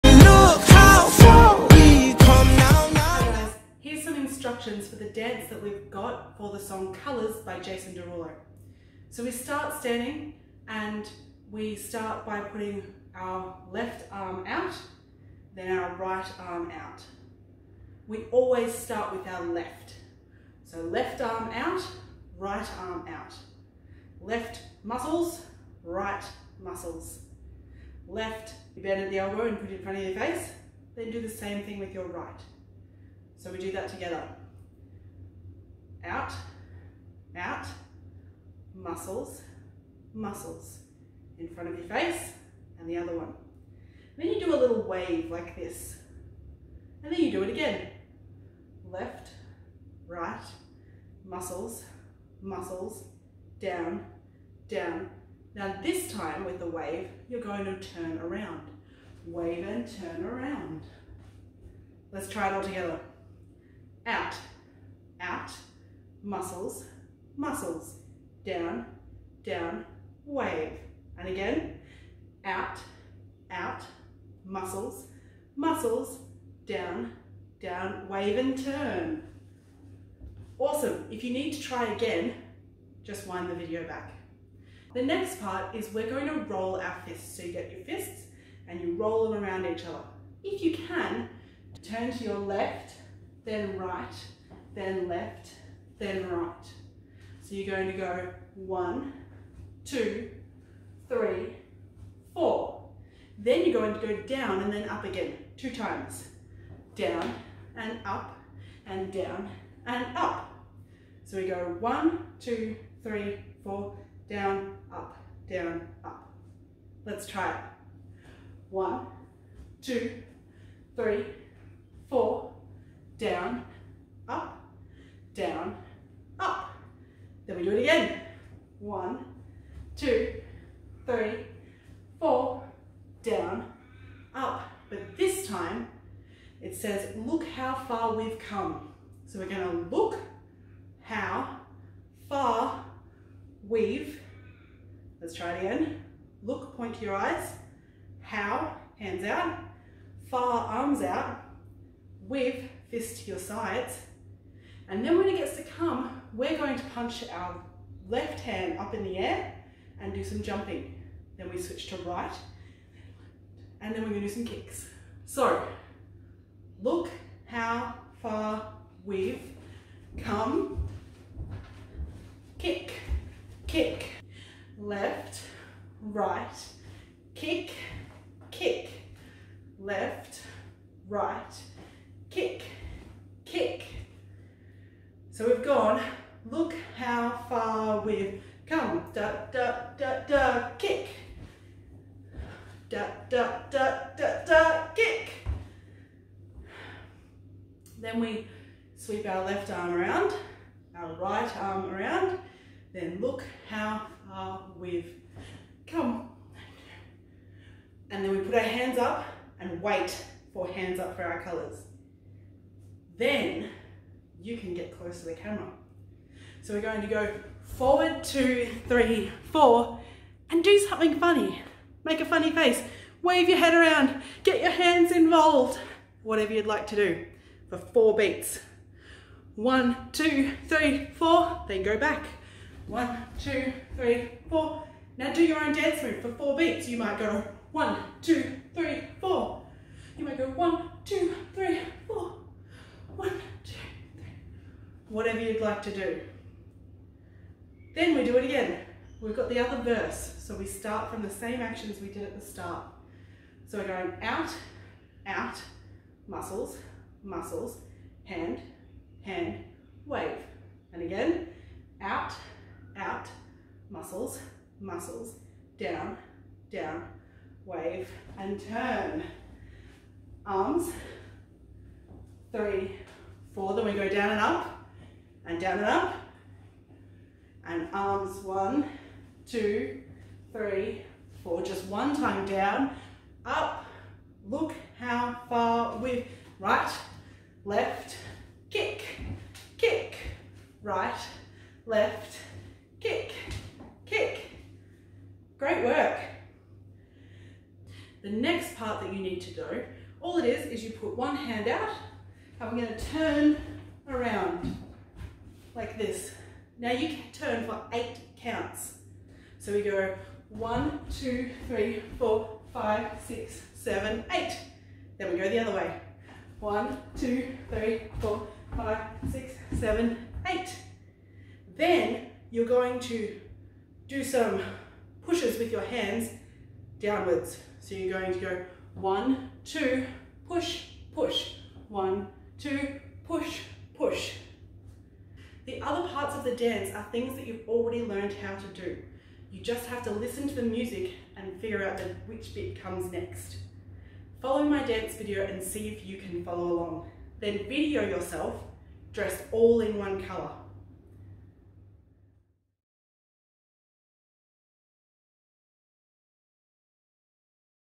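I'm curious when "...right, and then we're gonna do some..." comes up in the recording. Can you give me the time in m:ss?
2:41.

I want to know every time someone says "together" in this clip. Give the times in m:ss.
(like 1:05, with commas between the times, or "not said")
0:33, 1:02.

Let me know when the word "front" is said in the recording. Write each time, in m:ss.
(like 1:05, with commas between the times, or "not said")
0:29, 0:41.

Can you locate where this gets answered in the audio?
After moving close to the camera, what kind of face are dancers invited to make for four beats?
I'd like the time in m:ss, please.
3:42.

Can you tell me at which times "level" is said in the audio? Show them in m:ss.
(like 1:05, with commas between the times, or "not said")
not said.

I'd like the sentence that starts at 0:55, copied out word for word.
Now this time with the wave, you're going to turn around.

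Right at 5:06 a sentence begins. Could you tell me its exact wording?
Now you turn for eight counts.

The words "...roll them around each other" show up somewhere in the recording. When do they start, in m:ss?
1:28.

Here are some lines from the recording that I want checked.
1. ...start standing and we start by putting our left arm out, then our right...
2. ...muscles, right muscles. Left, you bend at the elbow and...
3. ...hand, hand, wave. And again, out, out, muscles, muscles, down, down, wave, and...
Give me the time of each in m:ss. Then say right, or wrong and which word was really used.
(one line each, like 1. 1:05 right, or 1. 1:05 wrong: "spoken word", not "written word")
1. 0:09 right
2. 0:24 right
3. 4:18 right.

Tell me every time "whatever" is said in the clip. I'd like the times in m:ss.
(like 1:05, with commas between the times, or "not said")
3:46, 4:05.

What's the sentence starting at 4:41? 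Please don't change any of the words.
Just one time down, up, look how far we've right, left, kick, kick, right, left, kick, kick.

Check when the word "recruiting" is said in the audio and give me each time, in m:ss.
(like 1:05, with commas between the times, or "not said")
not said.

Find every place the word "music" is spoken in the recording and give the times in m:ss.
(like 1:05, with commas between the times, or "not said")
5:40.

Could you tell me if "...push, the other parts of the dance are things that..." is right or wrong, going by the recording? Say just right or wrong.
right.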